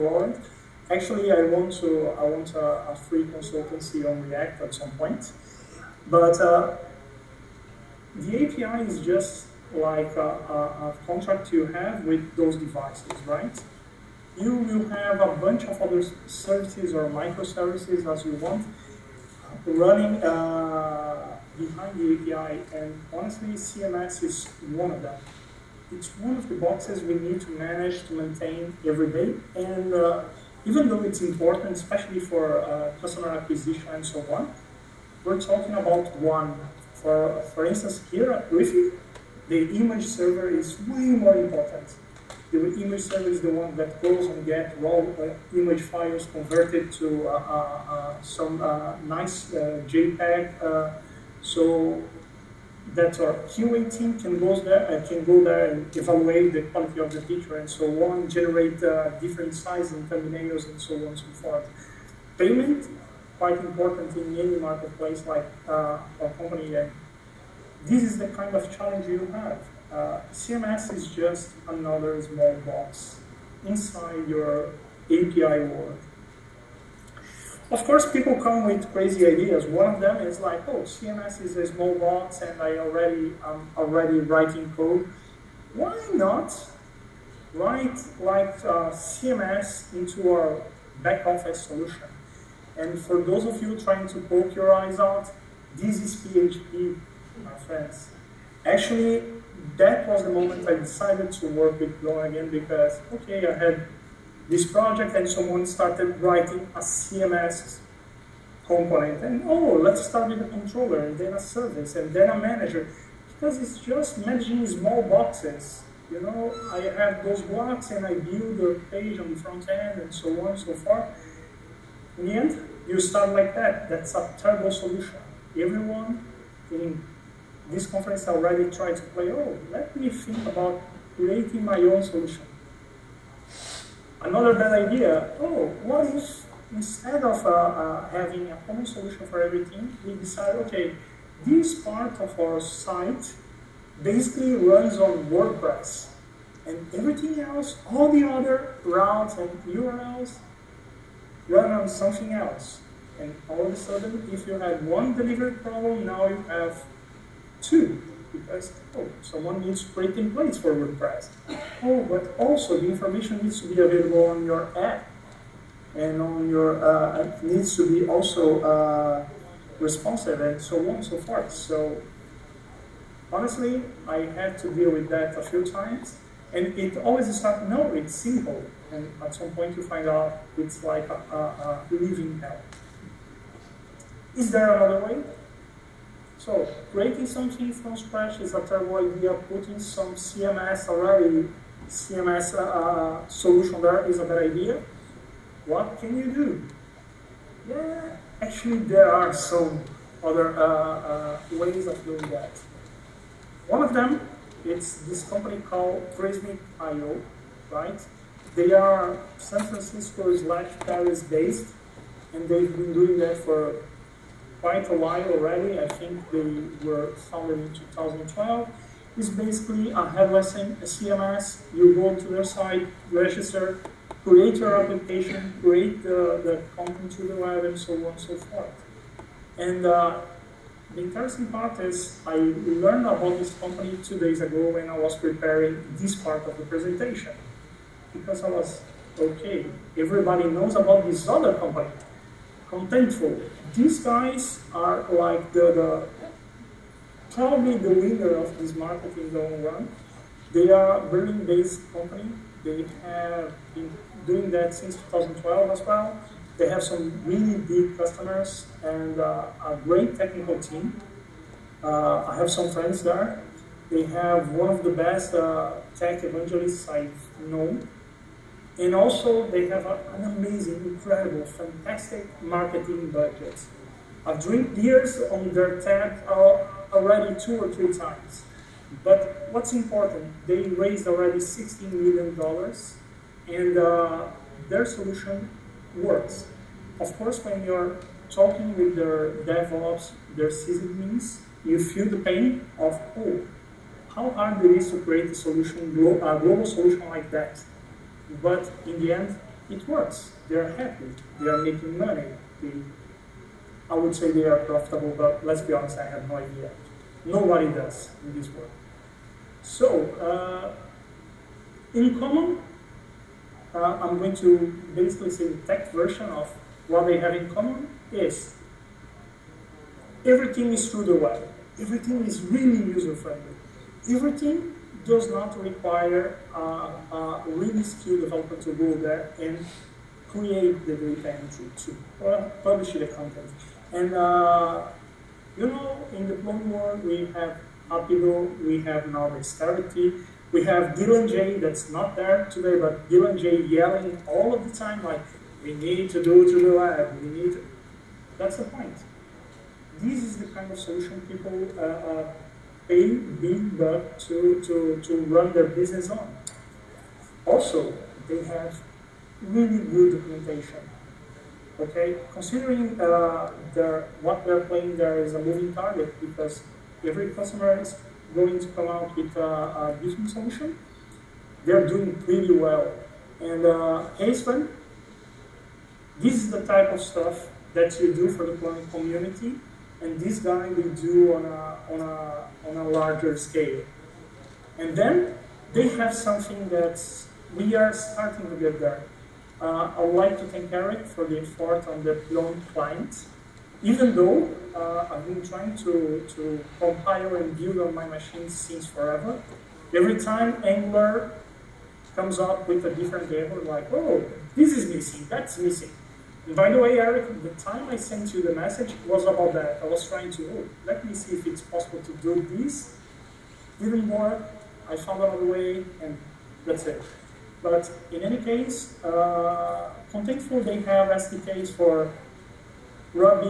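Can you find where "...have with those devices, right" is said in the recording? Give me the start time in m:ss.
0:11.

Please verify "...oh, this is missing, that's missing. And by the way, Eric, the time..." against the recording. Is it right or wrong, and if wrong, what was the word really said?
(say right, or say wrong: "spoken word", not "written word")
right.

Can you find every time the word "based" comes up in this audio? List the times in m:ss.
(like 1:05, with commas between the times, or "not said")
3:31, 4:11.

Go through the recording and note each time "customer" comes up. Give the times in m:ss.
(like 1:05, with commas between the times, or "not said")
0:33, 4:17, 6:07.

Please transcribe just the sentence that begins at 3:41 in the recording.
You go to their site, register, create your application, create the, the content to the web, and so on and so forth.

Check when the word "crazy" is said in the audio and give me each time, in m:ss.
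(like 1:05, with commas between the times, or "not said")
1:18.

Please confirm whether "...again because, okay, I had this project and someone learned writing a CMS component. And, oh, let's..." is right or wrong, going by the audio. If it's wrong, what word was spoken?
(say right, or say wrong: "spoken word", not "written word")
wrong: "started", not "learned".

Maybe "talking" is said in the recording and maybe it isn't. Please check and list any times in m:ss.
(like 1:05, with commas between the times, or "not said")
0:35, 4:48.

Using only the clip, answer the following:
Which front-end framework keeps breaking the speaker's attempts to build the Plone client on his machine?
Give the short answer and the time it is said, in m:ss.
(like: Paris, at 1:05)
Angular, at 6:40.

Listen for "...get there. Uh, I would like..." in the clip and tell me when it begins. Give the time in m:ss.
6:28.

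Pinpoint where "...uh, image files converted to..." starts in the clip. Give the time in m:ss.
0:44.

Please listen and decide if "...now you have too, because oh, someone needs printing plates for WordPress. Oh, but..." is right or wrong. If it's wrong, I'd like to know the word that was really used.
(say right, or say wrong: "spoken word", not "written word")
right.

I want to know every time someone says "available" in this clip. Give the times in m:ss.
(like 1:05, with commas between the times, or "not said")
2:43.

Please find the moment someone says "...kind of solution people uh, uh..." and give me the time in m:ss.
5:50.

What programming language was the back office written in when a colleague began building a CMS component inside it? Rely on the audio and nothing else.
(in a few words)
PHP.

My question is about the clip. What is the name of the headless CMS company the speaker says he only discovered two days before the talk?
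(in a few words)
Prismic.io.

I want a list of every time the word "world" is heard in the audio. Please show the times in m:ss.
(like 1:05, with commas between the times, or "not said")
1:15, 5:08, 5:36.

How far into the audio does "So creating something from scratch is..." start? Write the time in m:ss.
3:06.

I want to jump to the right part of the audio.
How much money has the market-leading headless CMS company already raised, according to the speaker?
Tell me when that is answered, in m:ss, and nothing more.
4:41.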